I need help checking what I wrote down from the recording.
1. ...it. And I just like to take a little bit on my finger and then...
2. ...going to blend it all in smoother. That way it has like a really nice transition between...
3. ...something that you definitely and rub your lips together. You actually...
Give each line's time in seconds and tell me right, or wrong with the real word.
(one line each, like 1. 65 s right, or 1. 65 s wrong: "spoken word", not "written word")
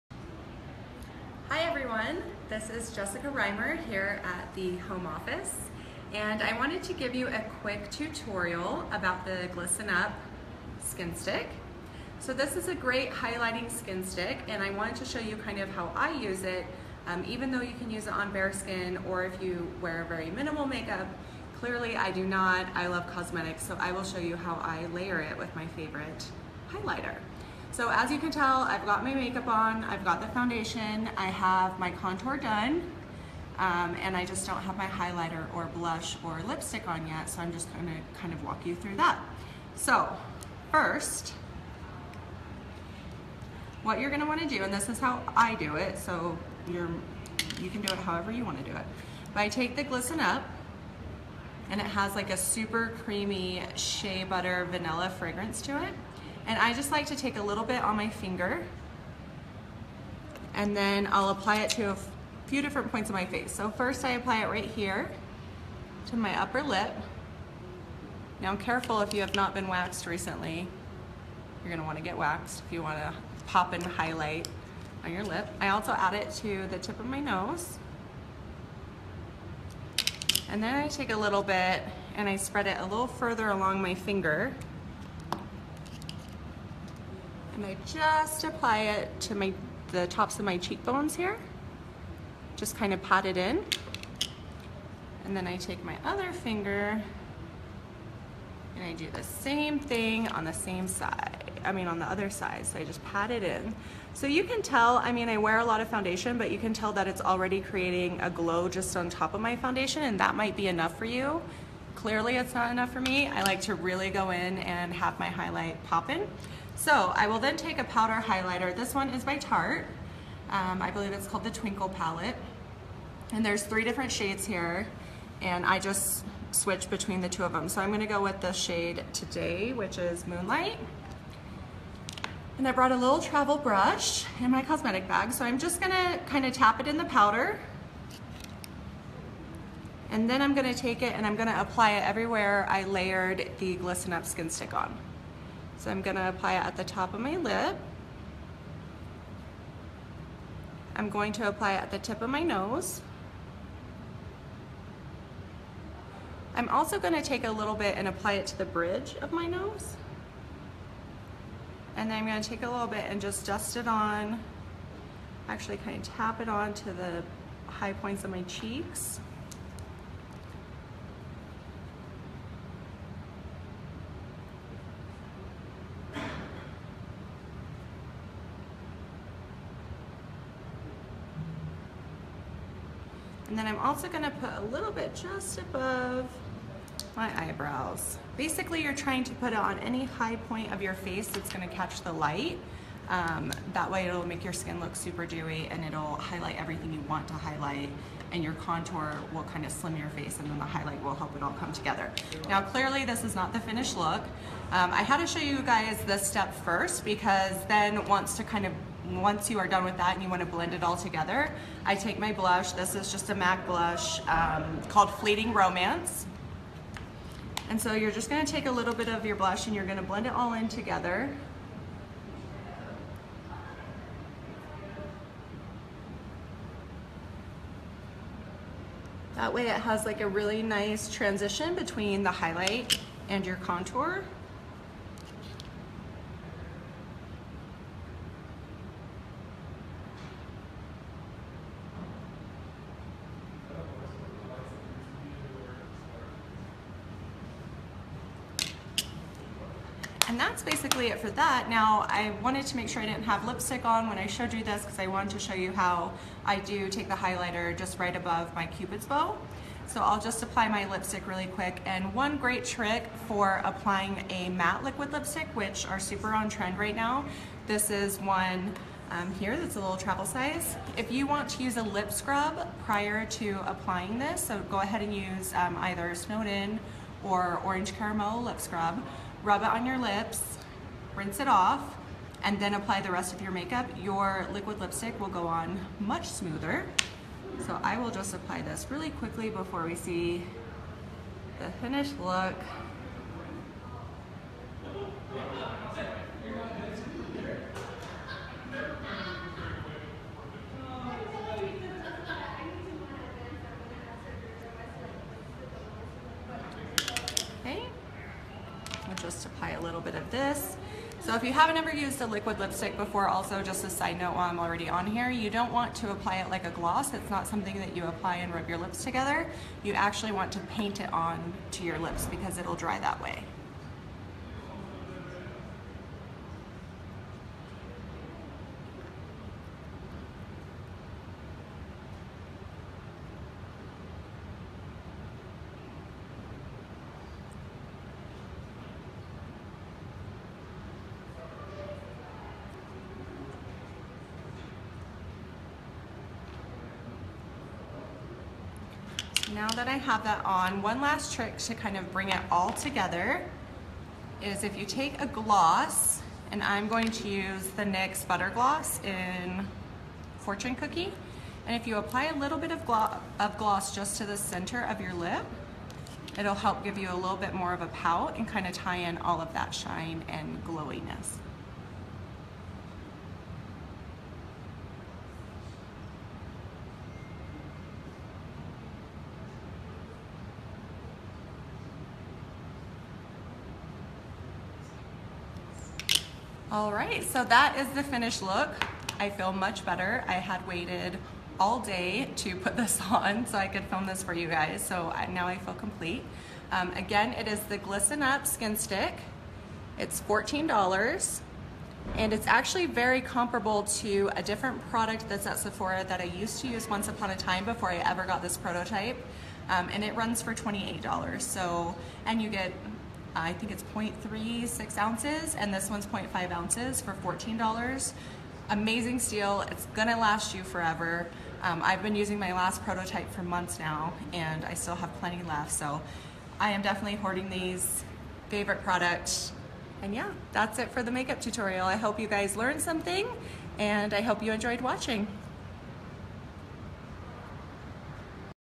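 1. 55 s right
2. 219 s wrong: "together", not "smoother"
3. 317 s wrong: "apply", not "definitely".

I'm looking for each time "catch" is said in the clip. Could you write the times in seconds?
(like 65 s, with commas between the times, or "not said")
191 s.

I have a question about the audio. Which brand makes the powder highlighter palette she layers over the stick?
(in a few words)
Tarte.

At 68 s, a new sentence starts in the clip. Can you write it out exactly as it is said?
Now I'm careful if you have not been waxed recently.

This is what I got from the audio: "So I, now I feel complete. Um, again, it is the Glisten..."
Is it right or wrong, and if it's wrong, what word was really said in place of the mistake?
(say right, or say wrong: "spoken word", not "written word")
right.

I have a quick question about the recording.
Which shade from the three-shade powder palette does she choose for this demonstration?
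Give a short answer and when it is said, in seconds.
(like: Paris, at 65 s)
Moonlight, at 130 s.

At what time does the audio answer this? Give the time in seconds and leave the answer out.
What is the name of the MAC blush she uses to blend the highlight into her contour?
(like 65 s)
215 s.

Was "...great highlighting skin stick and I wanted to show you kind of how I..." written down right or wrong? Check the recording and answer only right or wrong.
right.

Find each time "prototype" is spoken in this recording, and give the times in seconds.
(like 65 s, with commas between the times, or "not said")
408 s, 422 s.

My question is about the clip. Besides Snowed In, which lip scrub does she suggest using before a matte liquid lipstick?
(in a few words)
Orange Cara-mellow.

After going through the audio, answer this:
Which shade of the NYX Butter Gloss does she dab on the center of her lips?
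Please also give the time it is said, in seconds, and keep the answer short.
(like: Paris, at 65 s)
Fortune Cookie, at 360 s.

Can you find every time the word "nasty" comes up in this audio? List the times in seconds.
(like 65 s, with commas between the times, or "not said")
not said.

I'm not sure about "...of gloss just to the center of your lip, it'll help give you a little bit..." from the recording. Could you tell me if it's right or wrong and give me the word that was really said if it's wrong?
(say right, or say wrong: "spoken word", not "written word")
right.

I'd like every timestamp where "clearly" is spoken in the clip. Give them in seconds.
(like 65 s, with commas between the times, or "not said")
21 s, 111 s, 202 s.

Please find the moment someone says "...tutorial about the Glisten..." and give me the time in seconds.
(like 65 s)
7 s.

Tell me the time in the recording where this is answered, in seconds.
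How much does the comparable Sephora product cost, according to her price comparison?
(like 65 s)
410 s.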